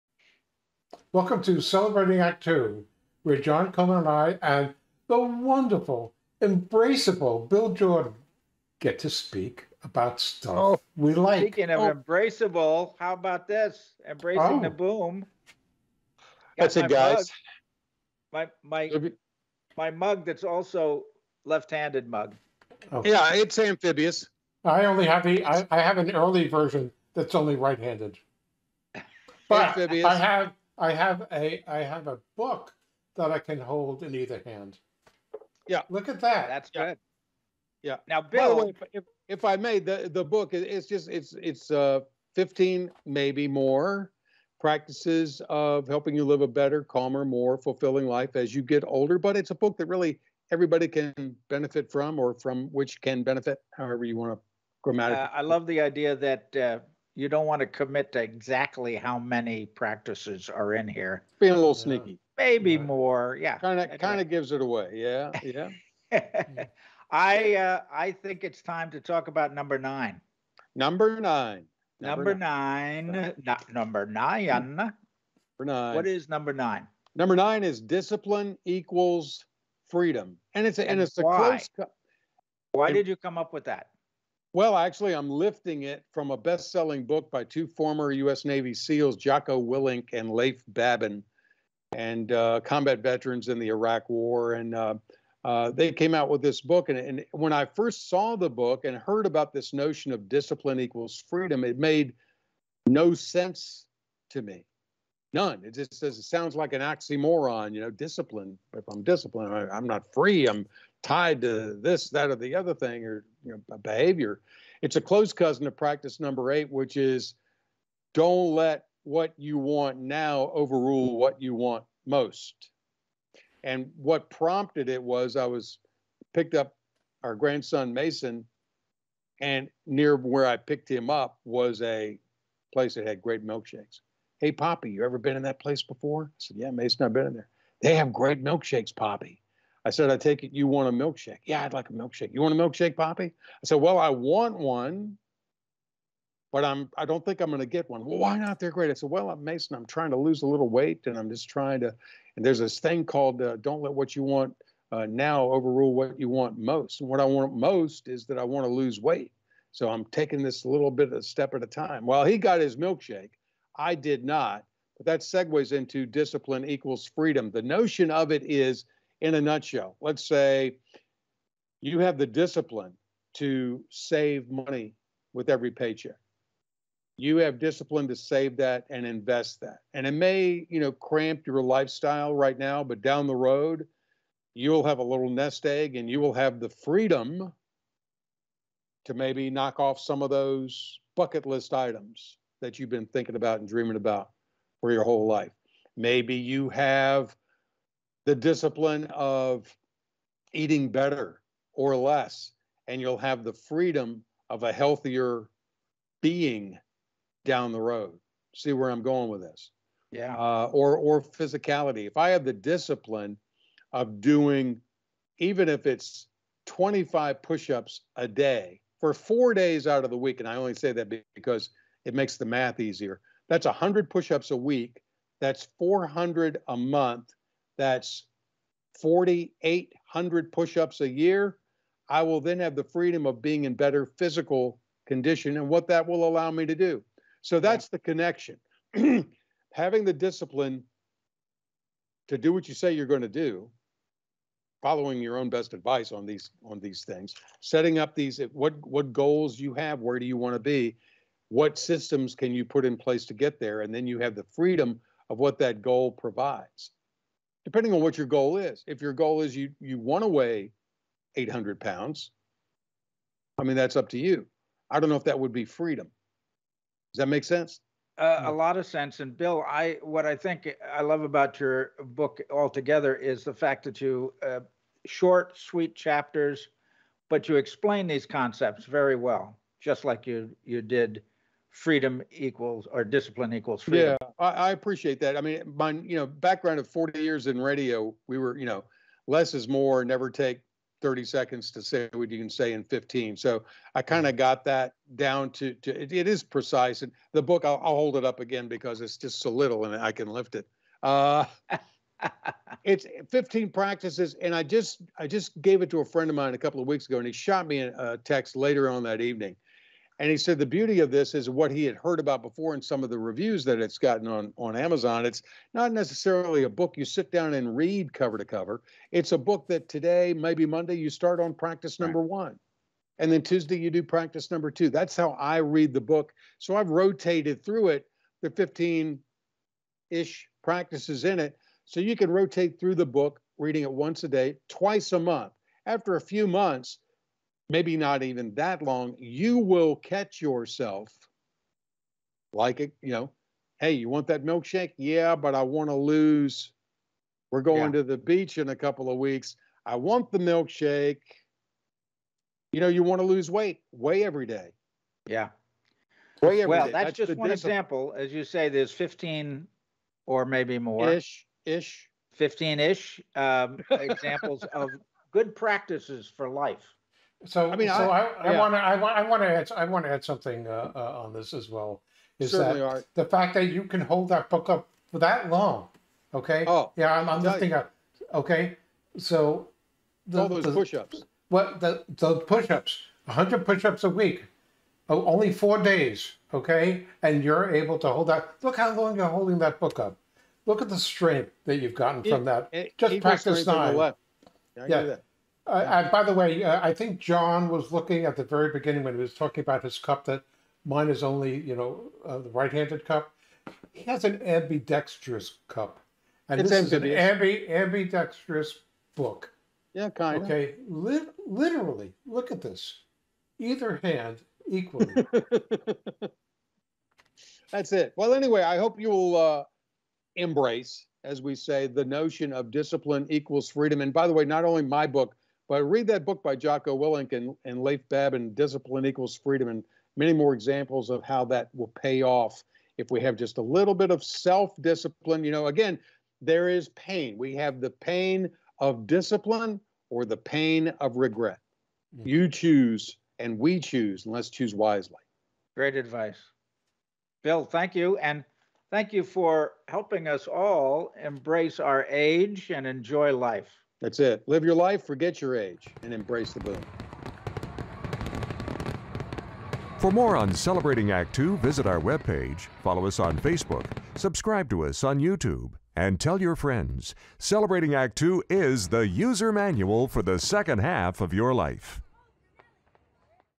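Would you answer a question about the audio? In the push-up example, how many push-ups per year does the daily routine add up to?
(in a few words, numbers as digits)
4,800.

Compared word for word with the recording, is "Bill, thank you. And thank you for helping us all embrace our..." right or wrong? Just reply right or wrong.
right.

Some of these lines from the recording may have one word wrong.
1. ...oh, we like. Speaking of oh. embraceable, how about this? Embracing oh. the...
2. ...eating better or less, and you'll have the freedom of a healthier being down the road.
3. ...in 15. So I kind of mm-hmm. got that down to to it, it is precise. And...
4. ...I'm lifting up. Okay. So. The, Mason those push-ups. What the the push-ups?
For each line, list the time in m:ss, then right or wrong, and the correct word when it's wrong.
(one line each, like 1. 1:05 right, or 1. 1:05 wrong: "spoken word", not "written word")
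1. 0:10 right
2. 3:20 right
3. 4:52 right
4. 6:17 wrong: "All", not "Mason".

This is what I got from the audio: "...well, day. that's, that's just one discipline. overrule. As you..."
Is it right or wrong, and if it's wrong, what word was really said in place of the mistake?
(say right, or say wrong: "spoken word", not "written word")
wrong: "example", not "overrule".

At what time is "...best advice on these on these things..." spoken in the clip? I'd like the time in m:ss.
4:05.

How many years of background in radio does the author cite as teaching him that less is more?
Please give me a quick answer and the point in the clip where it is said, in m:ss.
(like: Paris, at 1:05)
40, at 4:46.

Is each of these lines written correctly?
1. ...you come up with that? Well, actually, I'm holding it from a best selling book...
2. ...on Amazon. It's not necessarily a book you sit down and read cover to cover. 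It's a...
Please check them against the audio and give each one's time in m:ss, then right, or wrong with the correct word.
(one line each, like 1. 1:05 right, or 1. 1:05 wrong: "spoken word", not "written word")
1. 1:23 wrong: "lifting", not "holding"
2. 5:14 right.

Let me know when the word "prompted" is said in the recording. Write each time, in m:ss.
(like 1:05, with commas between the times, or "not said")
2:04.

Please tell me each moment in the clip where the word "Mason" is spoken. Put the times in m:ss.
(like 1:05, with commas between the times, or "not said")
2:07, 2:16, 2:29.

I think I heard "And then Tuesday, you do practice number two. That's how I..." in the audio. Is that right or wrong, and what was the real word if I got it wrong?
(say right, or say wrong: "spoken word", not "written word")
right.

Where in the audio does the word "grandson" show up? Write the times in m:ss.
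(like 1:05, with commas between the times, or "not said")
2:07.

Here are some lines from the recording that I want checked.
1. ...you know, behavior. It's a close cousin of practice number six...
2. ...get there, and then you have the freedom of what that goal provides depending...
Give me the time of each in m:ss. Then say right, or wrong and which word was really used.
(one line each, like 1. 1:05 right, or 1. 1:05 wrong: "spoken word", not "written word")
1. 1:53 wrong: "eight", not "six"
2. 4:13 right.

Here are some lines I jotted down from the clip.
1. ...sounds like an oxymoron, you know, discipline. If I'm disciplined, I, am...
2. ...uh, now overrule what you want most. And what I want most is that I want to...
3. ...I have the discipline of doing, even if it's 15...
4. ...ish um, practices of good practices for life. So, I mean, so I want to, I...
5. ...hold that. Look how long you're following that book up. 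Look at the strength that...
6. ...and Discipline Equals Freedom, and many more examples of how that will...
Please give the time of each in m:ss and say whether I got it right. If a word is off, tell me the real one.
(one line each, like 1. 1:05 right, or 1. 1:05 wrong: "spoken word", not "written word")
1. 1:46 right
2. 2:34 right
3. 3:32 wrong: "25", not "15"
4. 6:02 wrong: "examples", not "practices"
5. 6:28 wrong: "holding", not "following"
6. 7:08 right.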